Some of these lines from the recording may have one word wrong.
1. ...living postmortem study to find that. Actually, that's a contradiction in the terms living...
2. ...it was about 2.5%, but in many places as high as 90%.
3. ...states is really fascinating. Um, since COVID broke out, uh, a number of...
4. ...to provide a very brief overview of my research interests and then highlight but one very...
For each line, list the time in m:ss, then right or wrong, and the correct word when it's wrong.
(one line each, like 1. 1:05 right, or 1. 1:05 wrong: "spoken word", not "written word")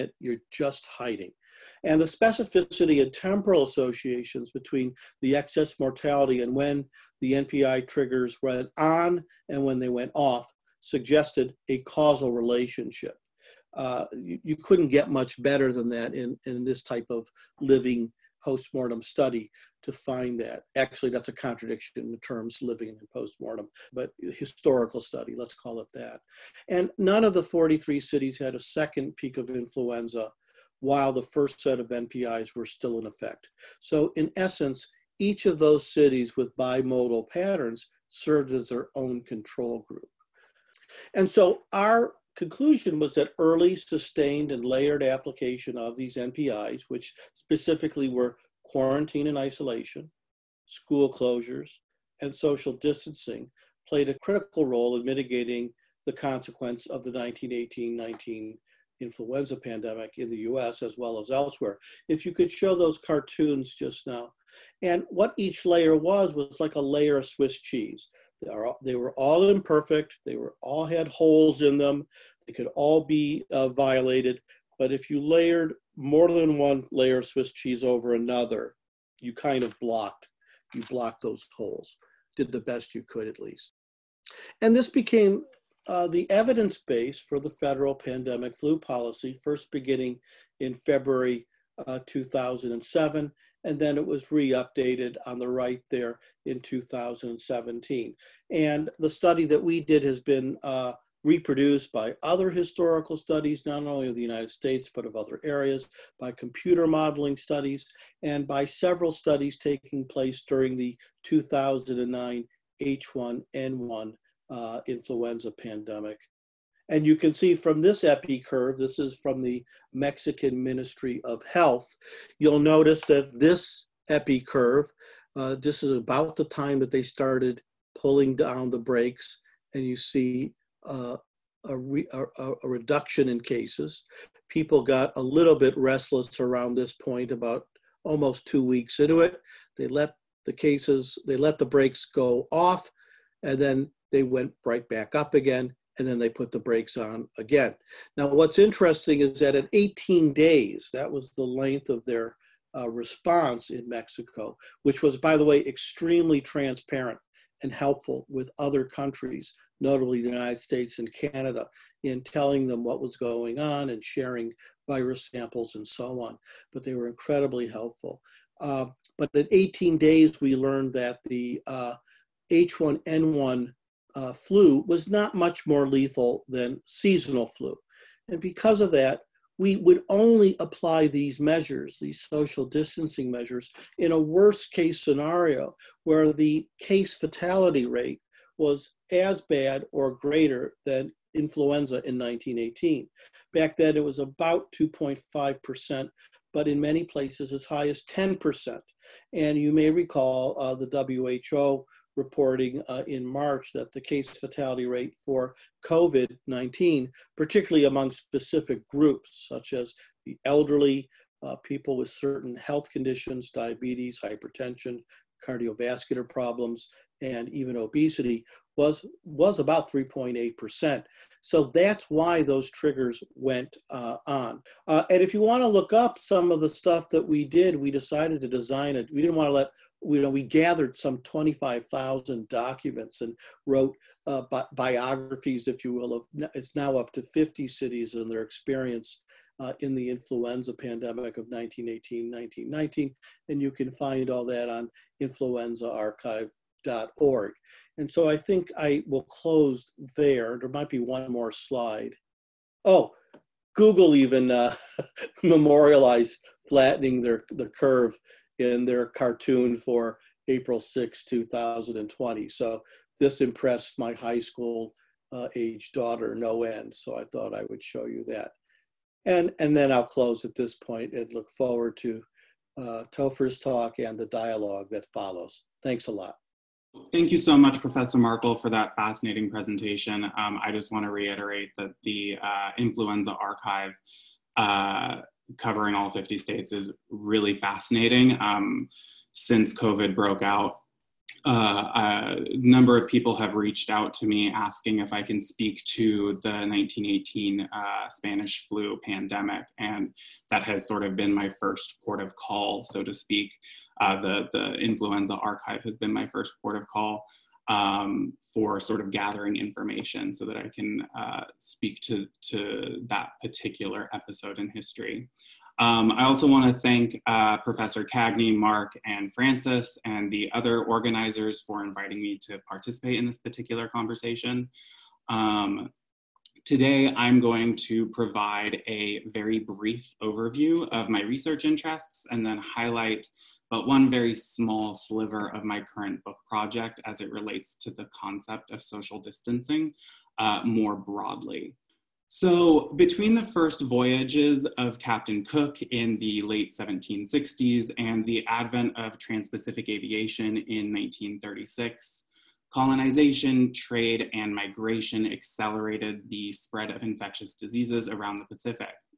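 1. 0:17 right
2. 3:13 wrong: "10", not "90"
3. 4:46 right
4. 5:27 right.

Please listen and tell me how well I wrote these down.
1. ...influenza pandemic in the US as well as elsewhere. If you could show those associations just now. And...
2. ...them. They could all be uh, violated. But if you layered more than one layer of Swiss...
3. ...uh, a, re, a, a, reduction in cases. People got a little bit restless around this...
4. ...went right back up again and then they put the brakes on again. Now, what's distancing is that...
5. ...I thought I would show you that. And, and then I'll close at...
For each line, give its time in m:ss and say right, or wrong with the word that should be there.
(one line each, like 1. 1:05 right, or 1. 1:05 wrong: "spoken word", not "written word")
1. 0:58 wrong: "cartoons", not "associations"
2. 1:11 right
3. 2:10 right
4. 2:24 wrong: "interesting", not "distancing"
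5. 4:27 right.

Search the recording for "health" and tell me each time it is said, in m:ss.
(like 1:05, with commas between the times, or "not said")
2:01, 3:32.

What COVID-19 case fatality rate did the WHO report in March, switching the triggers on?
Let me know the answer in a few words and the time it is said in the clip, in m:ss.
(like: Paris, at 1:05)
3.8%, at 3:39.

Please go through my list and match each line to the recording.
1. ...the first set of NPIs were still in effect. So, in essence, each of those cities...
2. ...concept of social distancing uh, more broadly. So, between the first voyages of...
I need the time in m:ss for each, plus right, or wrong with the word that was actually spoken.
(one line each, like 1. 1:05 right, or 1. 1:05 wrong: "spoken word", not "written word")
1. 0:31 right
2. 5:38 right.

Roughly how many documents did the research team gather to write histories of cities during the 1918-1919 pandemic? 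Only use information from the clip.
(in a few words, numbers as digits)
25,000.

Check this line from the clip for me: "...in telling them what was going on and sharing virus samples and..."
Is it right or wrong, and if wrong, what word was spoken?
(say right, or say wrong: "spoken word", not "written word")
right.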